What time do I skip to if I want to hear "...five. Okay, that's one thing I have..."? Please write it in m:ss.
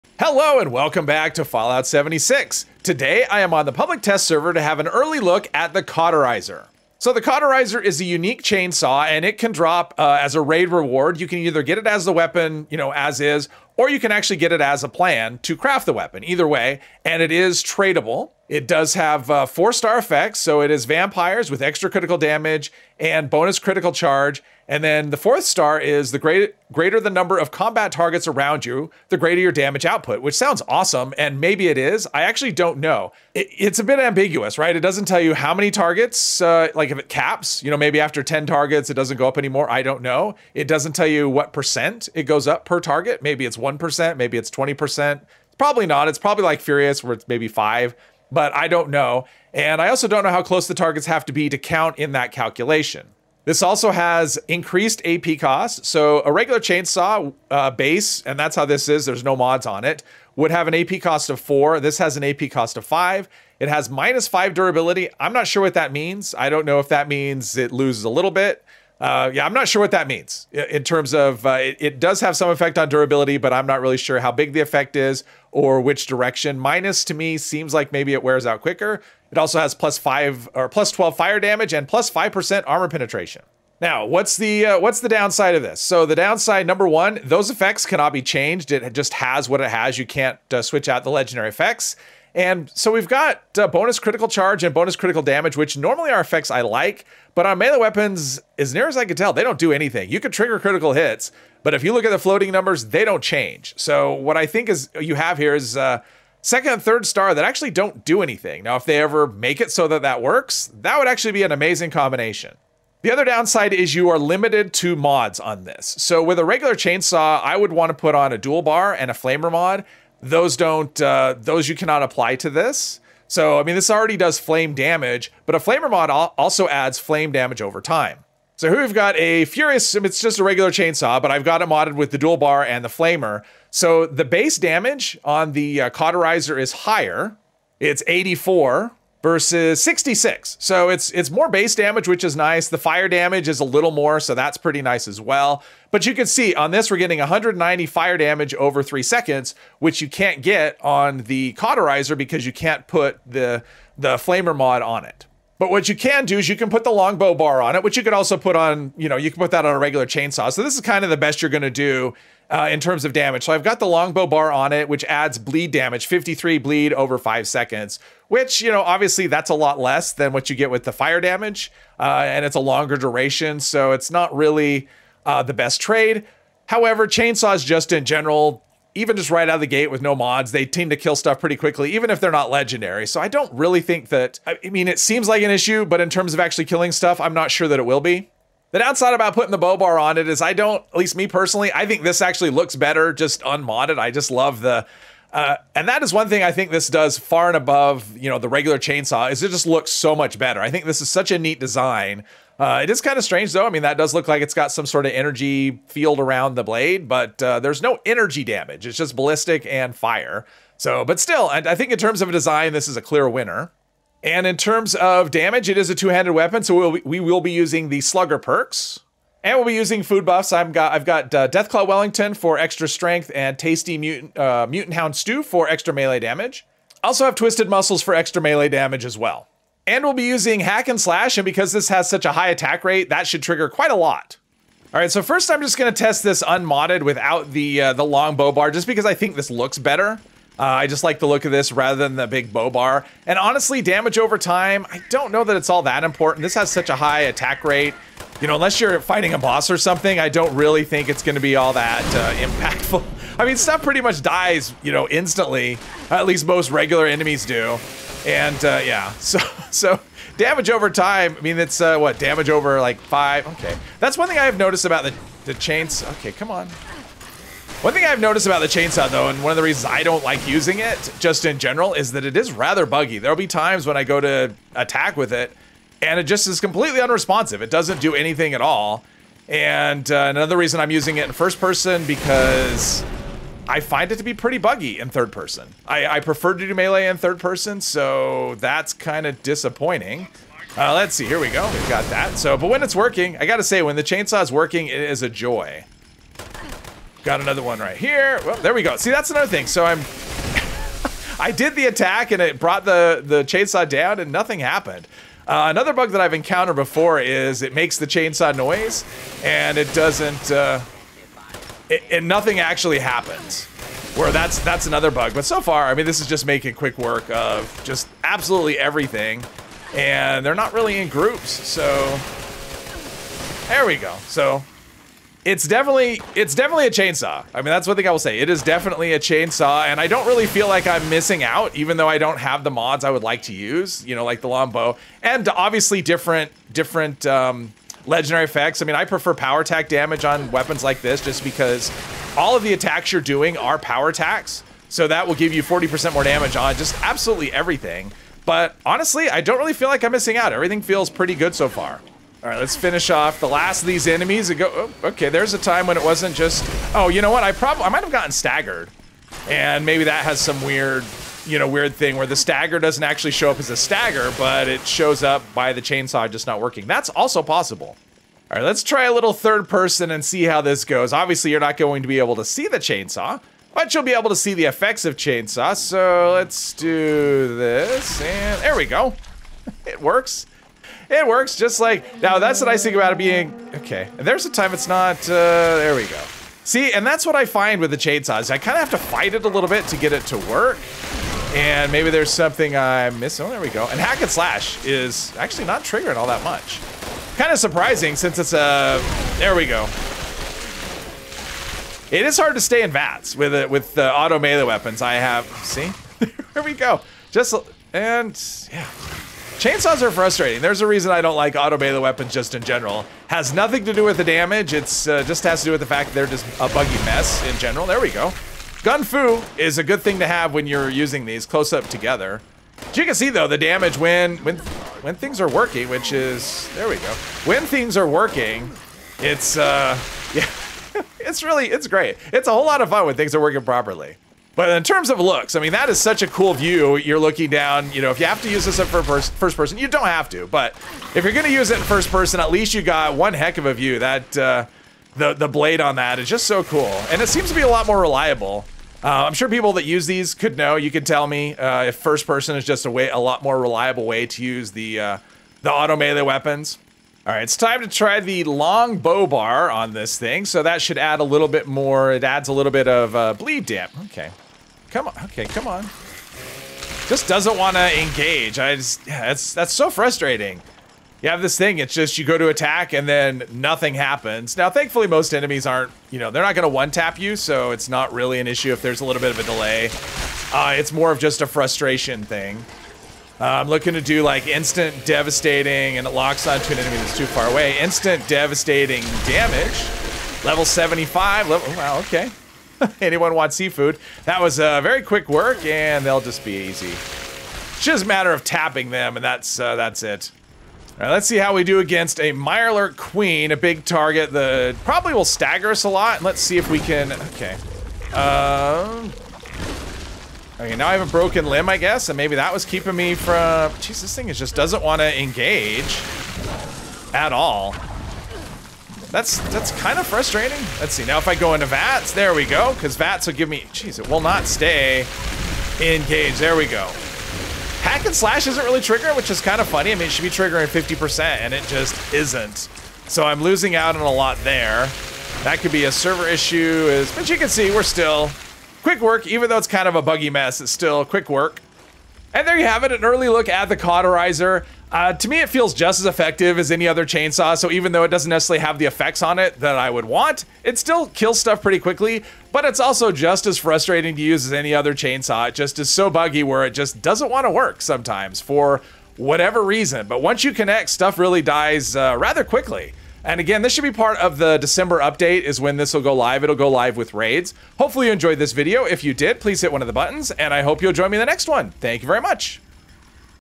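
4:22.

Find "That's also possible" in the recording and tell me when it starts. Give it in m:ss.
6:06.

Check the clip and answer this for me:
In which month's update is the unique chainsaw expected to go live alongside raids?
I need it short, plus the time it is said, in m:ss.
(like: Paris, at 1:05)
December, at 9:24.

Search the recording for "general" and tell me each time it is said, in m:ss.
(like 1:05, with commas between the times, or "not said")
2:58, 4:31, 6:52, 6:57.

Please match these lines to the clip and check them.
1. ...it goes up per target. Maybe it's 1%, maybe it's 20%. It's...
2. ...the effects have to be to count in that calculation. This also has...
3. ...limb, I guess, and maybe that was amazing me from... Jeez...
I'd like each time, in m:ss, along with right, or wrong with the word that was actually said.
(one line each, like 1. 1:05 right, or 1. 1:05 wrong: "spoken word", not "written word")
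1. 0:42 right
2. 0:50 wrong: "targets", not "effects"
3. 8:31 wrong: "keeping", not "amazing".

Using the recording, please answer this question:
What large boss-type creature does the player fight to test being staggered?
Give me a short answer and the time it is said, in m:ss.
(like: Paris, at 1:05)
Mirelurk Queen, at 8:22.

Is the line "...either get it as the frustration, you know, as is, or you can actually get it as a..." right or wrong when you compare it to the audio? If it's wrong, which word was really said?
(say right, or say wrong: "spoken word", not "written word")
wrong: "weapon", not "frustration".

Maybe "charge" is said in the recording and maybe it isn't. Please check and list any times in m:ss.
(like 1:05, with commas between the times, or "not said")
0:23, 1:34.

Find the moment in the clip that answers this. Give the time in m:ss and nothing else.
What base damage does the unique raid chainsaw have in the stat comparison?
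2:18.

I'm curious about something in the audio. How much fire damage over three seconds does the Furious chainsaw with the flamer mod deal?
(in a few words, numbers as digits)
190.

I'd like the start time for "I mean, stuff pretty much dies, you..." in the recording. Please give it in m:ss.
4:13.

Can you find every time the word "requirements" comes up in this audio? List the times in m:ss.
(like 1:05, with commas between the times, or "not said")
not said.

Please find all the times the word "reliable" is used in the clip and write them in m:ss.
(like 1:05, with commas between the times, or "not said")
7:28, 7:33.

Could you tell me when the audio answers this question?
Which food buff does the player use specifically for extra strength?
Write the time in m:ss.
3:41.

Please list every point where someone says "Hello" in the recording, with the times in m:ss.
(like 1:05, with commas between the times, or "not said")
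0:00.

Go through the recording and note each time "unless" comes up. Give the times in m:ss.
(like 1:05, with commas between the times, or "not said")
4:08.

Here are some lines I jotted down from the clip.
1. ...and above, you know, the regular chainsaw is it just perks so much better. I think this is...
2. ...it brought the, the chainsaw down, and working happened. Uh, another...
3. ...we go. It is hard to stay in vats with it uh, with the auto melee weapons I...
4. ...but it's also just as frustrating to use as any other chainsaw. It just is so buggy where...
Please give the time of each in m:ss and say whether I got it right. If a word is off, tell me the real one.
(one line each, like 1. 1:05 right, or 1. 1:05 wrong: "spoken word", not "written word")
1. 3:17 wrong: "looks", not "perks"
2. 5:02 wrong: "nothing", not "working"
3. 6:39 right
4. 9:12 right.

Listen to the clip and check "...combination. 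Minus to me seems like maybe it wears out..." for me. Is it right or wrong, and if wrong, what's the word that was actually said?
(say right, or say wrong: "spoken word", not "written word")
wrong: "direction", not "combination".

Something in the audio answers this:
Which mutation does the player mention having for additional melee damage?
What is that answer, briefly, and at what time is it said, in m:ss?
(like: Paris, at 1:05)
Twisted Muscles, at 3:47.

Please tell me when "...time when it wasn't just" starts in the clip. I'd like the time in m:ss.
5:55.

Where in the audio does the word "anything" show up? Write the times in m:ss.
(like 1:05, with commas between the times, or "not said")
1:39, 1:48, 4:38.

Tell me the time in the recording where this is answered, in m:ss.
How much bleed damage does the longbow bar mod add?
2:46.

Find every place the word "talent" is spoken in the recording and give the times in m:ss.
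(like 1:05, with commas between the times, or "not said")
not said.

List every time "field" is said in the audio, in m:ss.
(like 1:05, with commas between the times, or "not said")
3:25.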